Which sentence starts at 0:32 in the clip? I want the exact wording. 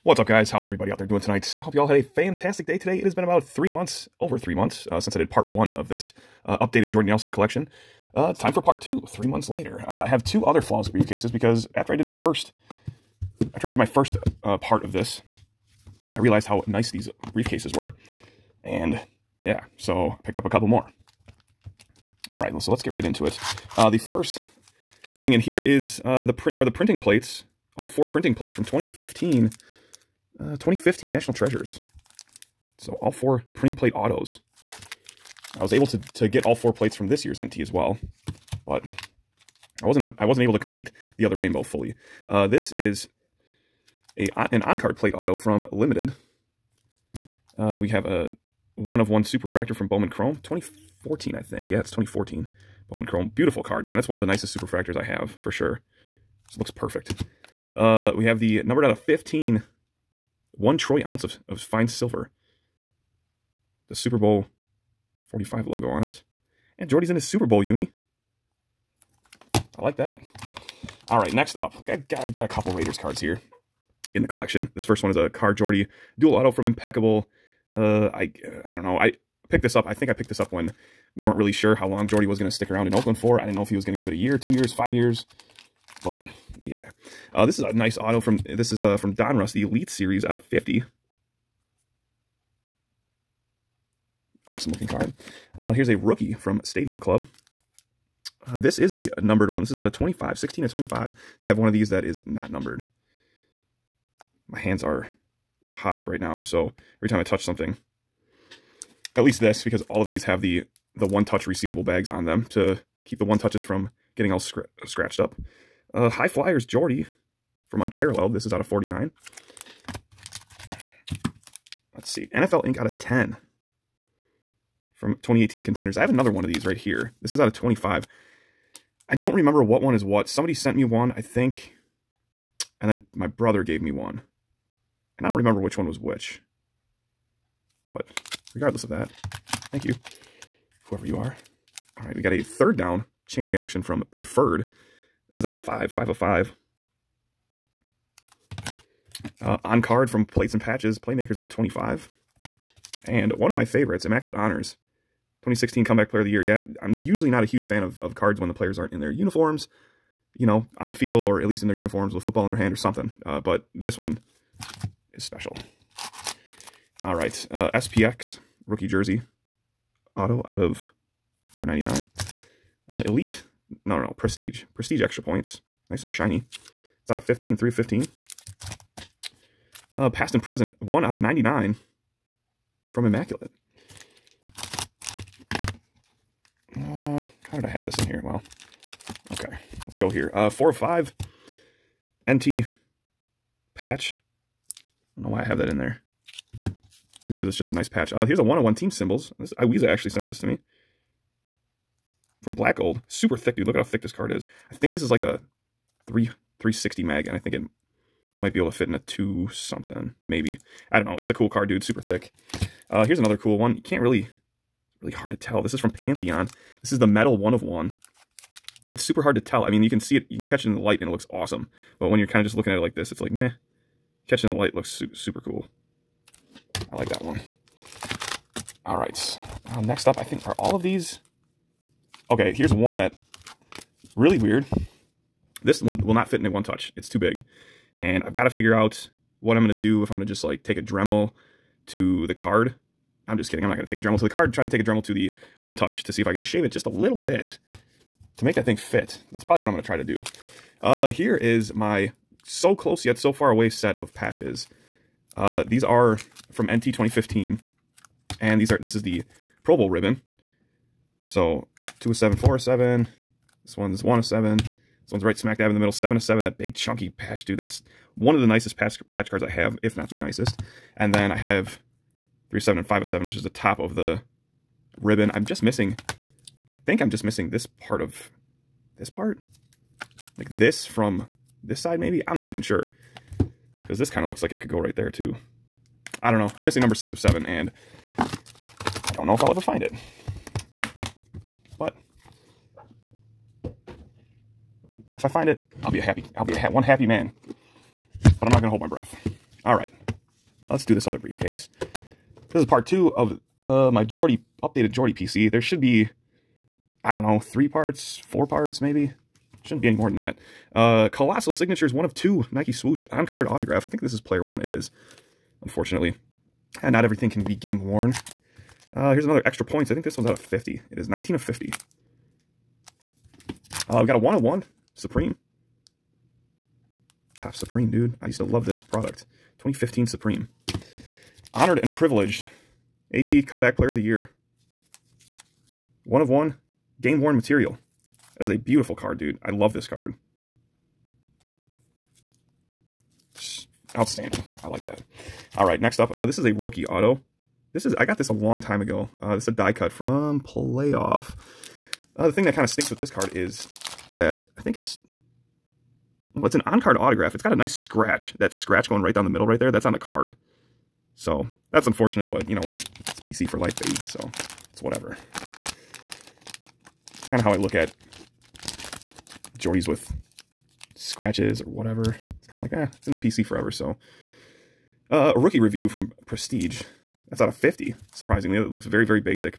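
So all four printing plate autos.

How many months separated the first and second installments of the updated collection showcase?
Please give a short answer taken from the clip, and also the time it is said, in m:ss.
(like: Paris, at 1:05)
3, at 0:09.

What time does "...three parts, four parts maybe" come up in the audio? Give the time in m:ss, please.
5:07.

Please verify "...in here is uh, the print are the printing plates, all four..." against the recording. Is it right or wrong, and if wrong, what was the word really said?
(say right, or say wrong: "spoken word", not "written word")
right.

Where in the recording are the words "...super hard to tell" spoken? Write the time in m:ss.
3:39.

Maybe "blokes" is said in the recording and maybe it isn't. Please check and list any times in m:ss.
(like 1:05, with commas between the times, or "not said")
not said.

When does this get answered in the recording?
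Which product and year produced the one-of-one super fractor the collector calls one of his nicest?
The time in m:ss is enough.
0:51.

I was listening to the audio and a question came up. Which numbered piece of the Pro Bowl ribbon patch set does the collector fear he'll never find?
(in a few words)
6 of 7.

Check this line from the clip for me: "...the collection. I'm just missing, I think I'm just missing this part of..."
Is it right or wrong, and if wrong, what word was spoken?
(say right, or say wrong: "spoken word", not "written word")
wrong: "ribbon", not "collection".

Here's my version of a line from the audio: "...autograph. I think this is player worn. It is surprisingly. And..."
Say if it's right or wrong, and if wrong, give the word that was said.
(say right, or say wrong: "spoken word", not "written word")
wrong: "unfortunately", not "surprisingly".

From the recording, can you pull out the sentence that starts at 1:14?
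This first one is a Carr Jordy dual auto from Impeccable uh, I, uh, I don't know.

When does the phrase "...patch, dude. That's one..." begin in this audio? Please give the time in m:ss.
4:27.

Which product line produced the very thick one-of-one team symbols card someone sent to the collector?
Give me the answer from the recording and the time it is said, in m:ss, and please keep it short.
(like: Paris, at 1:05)
Black Gold, at 3:22.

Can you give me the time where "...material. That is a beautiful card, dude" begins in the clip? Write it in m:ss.
5:37.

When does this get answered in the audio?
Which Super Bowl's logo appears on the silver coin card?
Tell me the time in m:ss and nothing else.
1:03.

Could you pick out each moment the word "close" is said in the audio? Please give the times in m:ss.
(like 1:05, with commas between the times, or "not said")
4:12.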